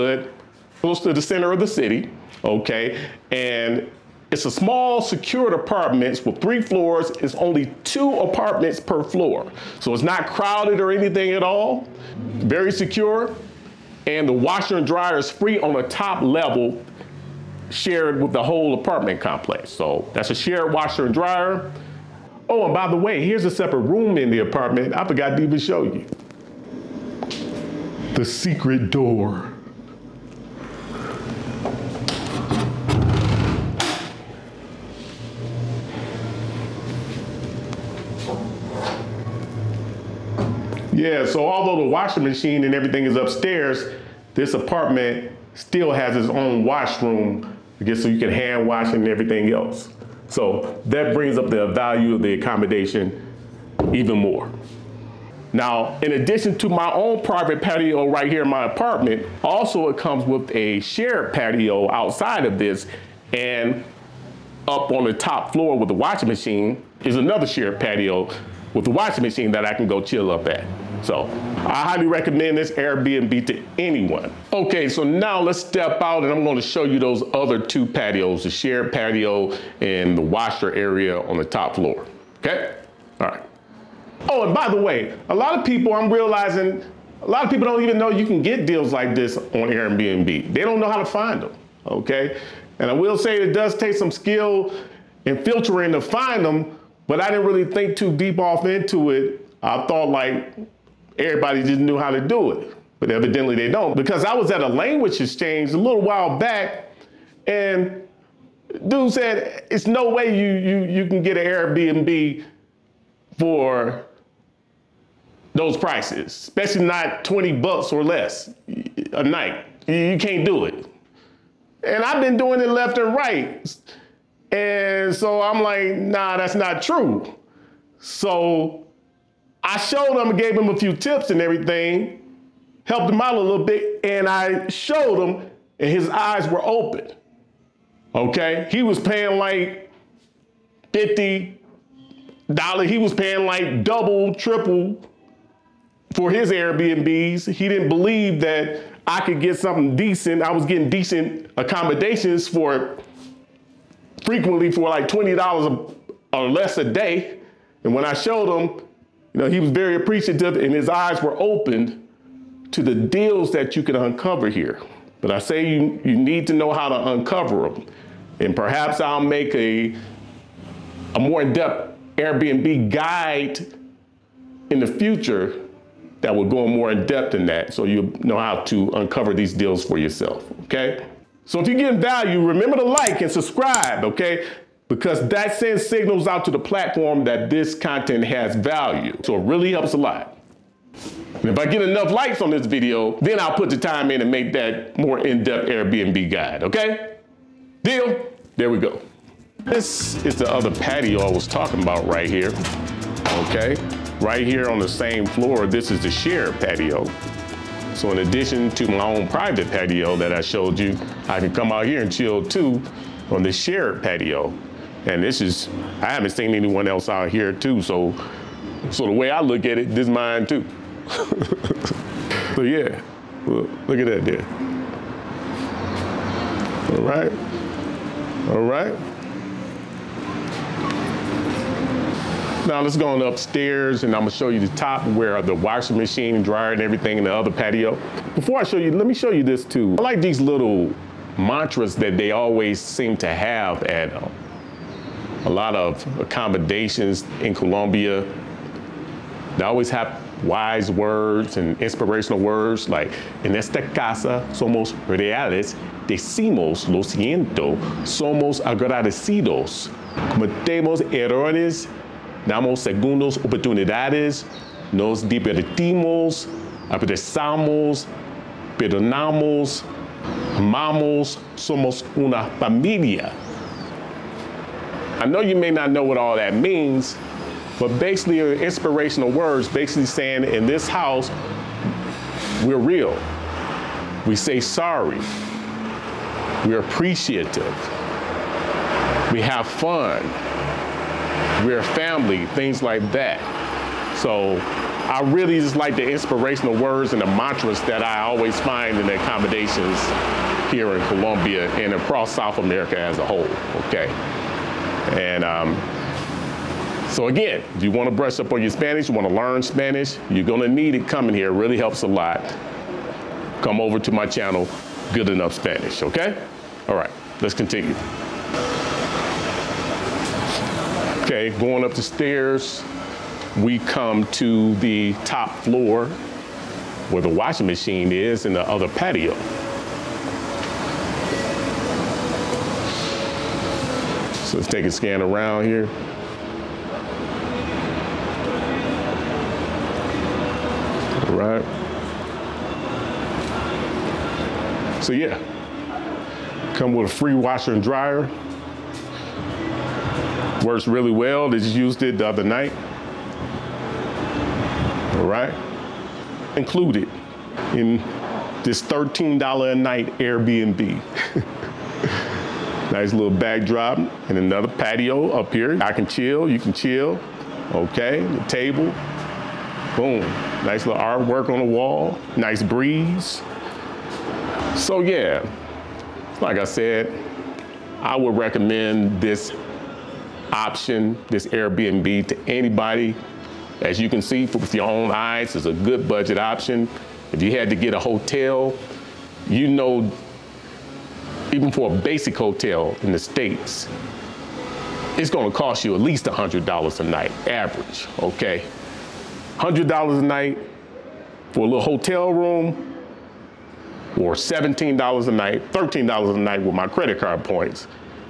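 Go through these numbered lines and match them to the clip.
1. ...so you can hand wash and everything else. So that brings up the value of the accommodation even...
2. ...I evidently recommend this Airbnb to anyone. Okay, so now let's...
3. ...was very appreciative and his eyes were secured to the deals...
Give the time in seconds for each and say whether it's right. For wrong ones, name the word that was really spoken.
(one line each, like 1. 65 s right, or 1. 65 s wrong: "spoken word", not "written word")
1. 48 s right
2. 71 s wrong: "highly", not "evidently"
3. 159 s wrong: "opened", not "secured".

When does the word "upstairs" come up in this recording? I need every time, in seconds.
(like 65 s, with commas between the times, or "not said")
43 s, 233 s.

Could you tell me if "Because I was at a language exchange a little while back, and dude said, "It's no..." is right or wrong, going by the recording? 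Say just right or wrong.
right.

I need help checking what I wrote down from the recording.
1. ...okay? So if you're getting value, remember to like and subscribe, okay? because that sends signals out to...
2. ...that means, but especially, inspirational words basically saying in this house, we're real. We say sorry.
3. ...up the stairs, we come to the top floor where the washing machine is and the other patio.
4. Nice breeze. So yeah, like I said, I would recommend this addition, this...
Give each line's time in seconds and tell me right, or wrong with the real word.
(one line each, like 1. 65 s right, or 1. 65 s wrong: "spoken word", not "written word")
1. 180 s right
2. 276 s wrong: "basically", not "especially"
3. 321 s right
4. 372 s wrong: "option", not "addition".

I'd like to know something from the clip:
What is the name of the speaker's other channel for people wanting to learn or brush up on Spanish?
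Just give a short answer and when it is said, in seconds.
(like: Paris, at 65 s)
Good Enough Spanish, at 315 s.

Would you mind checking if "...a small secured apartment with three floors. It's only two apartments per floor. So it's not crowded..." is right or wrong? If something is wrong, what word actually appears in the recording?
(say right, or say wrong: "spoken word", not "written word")
right.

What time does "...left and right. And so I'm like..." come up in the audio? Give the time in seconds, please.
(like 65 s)
122 s.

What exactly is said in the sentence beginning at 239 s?
I like these little mantras that they always seem to have at um, a lot of accommodations in Colombia.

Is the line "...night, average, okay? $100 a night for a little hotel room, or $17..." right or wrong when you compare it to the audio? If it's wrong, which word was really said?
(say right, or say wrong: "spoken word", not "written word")
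right.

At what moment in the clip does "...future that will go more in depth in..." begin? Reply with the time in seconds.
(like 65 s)
174 s.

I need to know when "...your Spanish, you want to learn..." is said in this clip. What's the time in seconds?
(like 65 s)
308 s.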